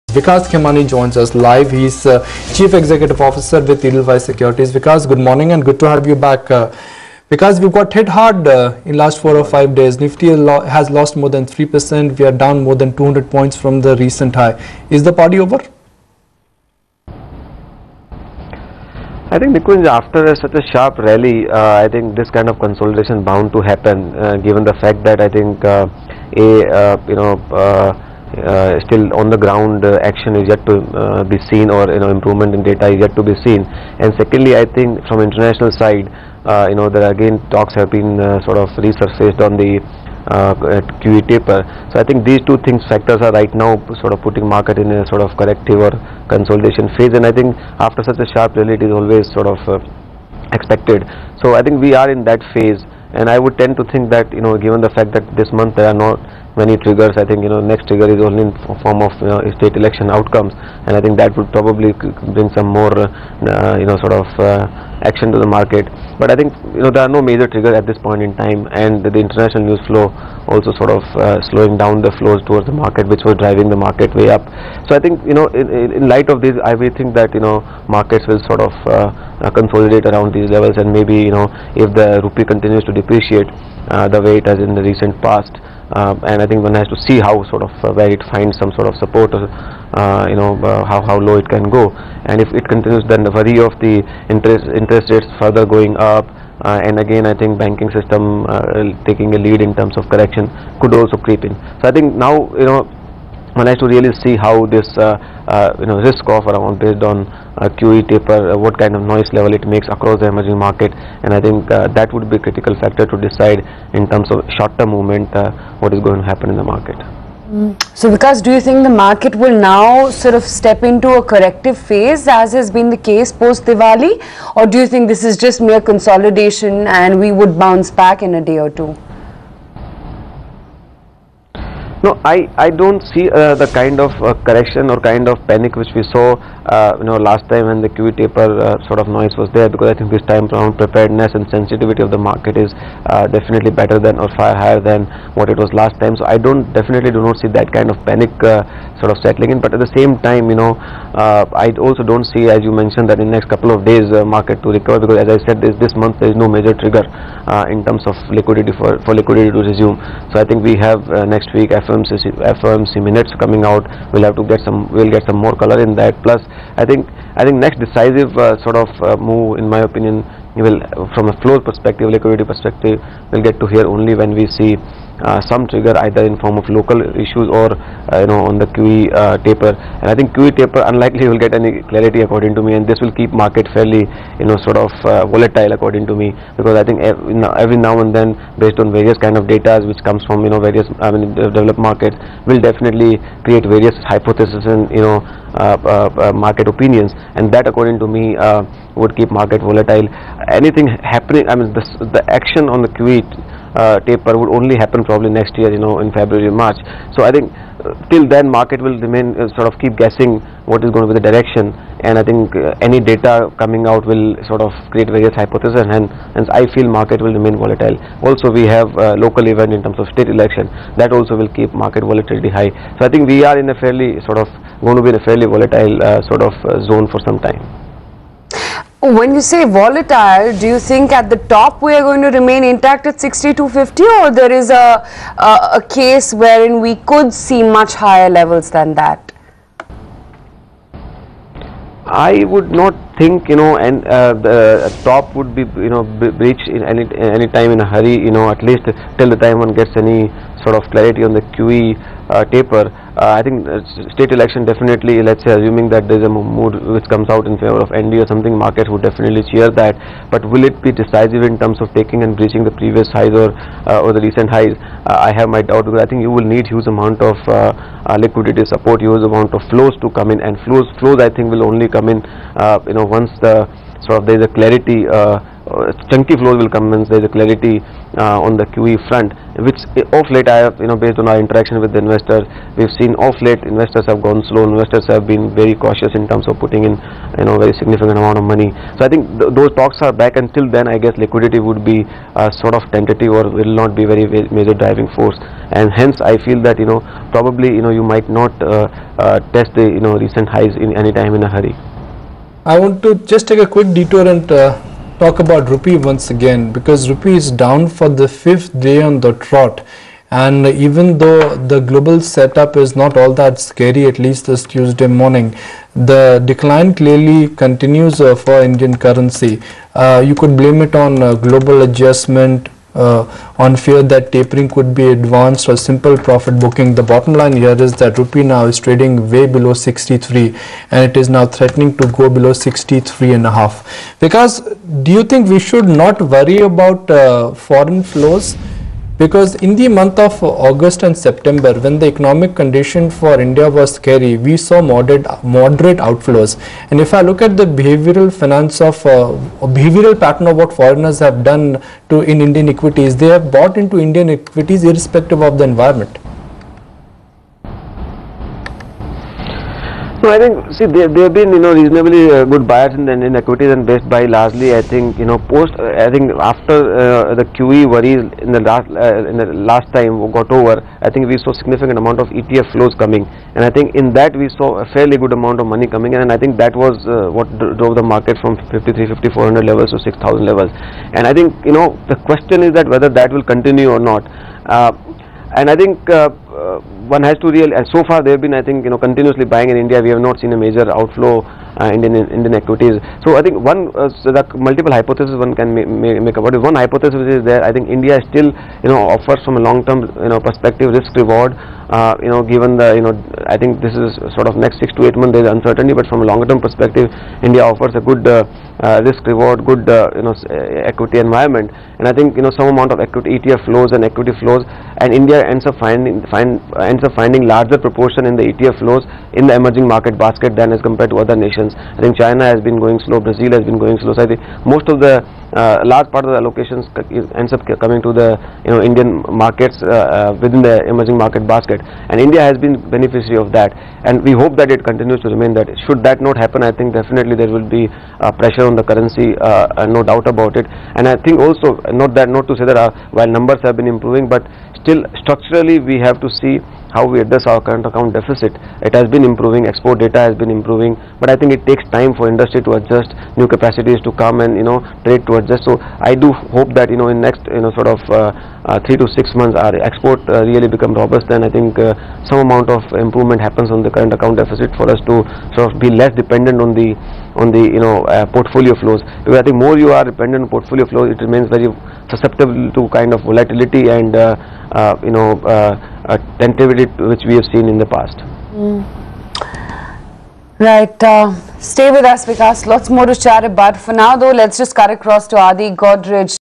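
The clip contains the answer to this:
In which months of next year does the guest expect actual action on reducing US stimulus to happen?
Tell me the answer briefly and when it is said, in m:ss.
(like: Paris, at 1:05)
February March, at 3:26.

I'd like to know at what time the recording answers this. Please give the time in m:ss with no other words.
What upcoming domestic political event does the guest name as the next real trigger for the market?
0:59.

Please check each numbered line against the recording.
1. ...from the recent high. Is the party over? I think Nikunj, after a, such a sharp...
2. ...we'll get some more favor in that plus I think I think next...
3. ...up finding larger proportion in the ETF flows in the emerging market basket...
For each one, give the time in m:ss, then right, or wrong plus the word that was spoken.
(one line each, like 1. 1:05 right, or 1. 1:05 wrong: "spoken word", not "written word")
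1. 0:13 right
2. 2:44 wrong: "color", not "favor"
3. 6:57 right.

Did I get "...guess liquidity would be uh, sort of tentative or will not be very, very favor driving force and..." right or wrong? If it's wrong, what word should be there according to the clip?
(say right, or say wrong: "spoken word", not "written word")
wrong: "major", not "favor".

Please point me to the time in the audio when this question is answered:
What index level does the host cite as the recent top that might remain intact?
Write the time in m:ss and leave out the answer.
3:53.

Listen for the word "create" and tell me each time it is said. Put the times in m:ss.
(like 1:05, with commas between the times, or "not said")
3:13, 3:34.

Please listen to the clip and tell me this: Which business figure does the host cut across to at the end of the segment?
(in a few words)
Adi Godrej.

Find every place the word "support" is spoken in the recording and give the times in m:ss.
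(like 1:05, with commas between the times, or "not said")
1:28, 4:28.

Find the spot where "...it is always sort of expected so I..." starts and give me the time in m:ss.
0:48.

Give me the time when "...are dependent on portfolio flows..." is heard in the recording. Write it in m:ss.
7:49.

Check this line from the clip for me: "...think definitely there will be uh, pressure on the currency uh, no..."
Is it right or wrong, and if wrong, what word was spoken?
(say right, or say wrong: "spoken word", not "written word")
right.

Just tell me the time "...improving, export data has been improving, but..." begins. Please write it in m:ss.
7:29.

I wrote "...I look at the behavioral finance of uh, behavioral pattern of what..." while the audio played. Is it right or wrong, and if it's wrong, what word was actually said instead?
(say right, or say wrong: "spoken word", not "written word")
right.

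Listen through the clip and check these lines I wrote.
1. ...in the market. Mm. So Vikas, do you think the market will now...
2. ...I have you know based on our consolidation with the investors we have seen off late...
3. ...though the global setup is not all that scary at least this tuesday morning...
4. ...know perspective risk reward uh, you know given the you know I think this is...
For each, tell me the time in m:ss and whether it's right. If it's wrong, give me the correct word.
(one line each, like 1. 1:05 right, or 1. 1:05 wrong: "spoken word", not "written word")
1. 1:56 right
2. 4:40 wrong: "interaction", not "consolidation"
3. 5:11 right
4. 6:40 right.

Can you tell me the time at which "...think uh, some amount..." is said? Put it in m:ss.
7:41.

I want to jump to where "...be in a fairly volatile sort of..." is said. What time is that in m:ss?
3:45.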